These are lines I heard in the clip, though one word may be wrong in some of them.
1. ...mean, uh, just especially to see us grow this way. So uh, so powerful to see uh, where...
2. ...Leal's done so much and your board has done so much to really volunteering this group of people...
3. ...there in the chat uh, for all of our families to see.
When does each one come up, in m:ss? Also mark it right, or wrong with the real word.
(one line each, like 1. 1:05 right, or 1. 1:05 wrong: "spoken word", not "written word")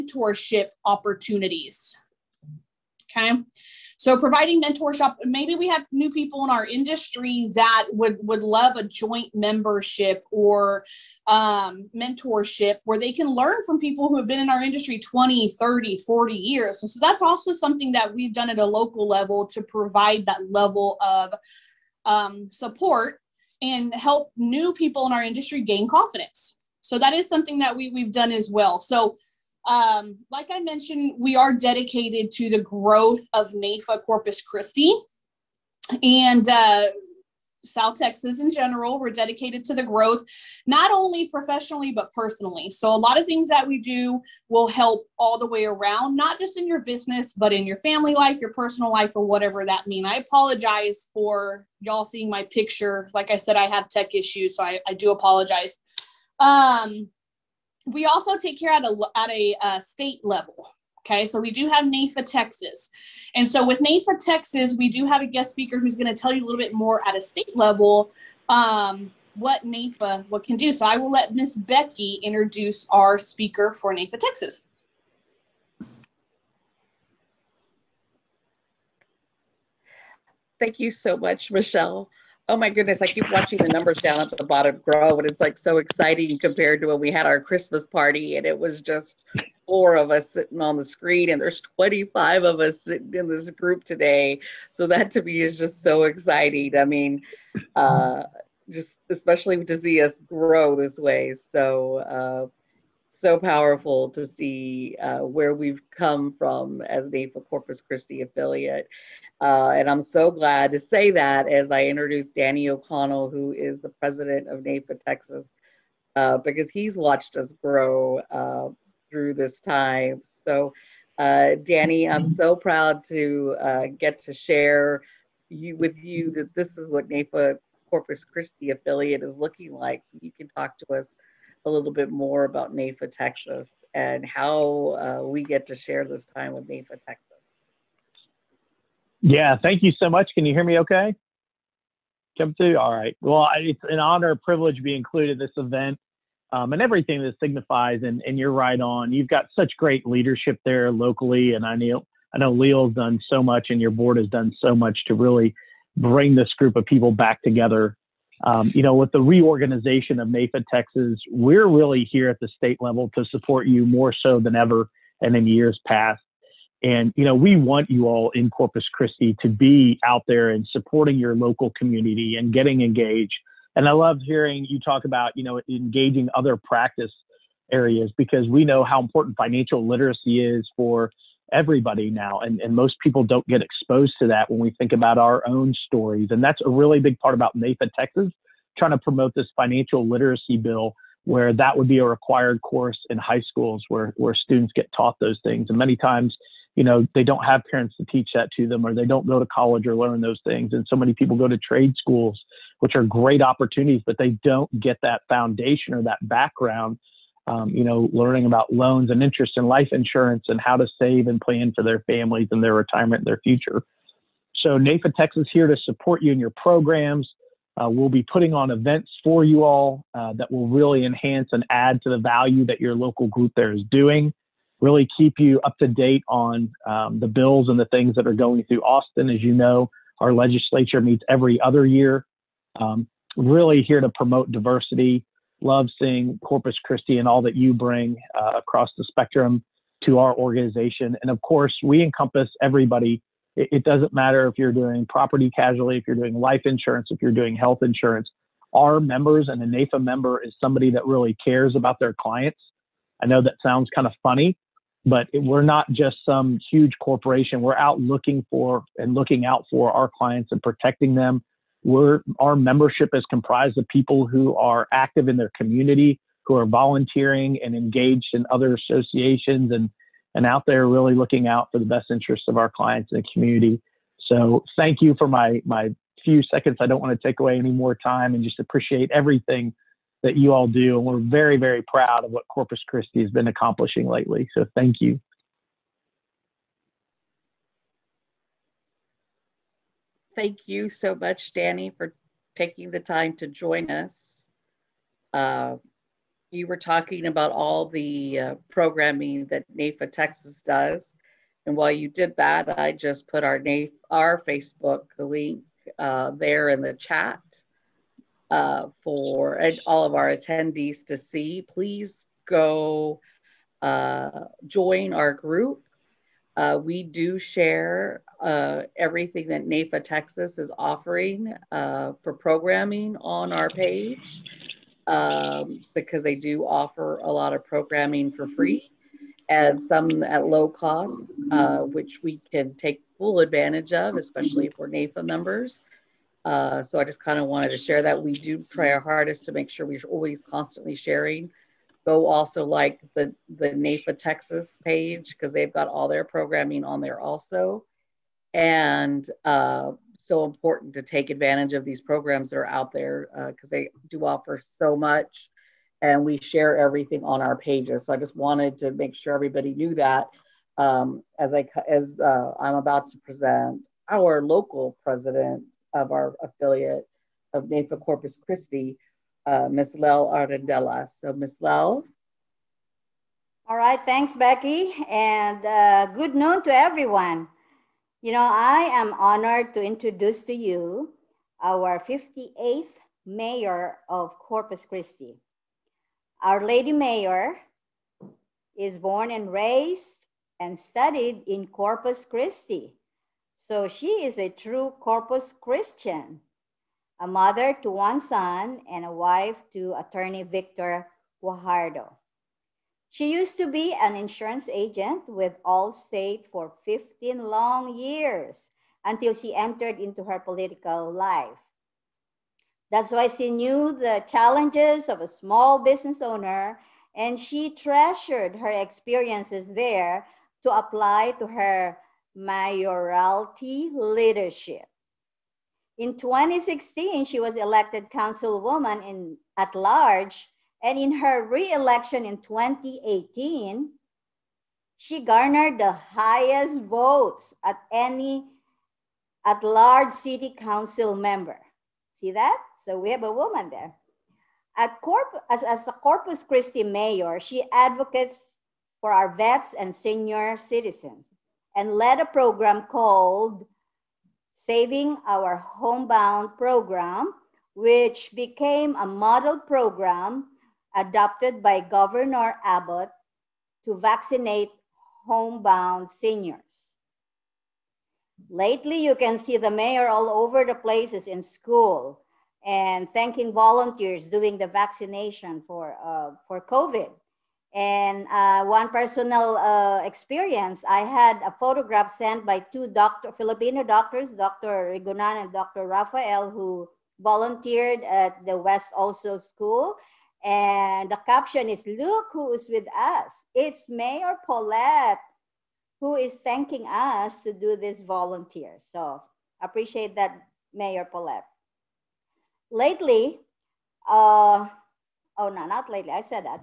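1. 1:36 right
2. 2:32 wrong: "bring", not "volunteering"
3. 5:06 wrong: "attendees", not "families".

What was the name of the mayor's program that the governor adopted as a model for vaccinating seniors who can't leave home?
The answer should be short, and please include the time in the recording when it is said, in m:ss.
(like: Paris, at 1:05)
Saving Our Homebound Program, at 7:34.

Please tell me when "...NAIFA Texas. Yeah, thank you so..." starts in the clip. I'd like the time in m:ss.
2:16.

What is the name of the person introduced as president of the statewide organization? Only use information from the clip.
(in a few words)
Danny O'Connell.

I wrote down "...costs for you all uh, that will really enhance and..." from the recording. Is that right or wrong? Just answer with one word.
wrong.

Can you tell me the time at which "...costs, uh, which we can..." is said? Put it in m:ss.
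5:30.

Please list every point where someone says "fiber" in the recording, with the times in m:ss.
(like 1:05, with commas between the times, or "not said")
not said.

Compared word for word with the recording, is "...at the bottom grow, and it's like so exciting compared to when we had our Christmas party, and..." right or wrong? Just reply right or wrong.
right.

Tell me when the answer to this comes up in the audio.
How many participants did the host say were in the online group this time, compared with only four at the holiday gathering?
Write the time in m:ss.
1:31.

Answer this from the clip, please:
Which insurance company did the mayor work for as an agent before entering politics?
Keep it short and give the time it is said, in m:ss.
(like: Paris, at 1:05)
Allstate, at 6:45.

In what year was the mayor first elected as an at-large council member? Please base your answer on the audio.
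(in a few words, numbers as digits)
2016.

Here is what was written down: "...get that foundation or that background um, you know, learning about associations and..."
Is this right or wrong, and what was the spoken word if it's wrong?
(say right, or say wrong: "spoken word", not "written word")
wrong: "loans", not "associations".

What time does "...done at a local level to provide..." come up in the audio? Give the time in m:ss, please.
0:18.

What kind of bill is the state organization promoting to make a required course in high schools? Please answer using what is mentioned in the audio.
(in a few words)
financial literacy bill.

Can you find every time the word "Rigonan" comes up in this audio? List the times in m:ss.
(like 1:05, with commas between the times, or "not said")
8:04.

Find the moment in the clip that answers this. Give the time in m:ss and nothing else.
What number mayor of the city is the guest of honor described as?
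6:21.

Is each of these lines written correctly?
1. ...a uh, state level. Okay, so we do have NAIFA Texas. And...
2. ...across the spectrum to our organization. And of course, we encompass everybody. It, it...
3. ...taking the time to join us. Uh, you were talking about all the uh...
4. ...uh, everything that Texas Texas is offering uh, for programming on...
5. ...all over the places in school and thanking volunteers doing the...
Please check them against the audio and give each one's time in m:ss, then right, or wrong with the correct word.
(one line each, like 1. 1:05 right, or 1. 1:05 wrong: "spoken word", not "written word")
1. 0:59 right
2. 3:58 right
3. 4:52 right
4. 5:18 wrong: "NAIFA", not "Texas"
5. 7:50 right.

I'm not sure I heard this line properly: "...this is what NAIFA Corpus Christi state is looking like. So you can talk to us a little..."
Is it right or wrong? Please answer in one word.
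wrong.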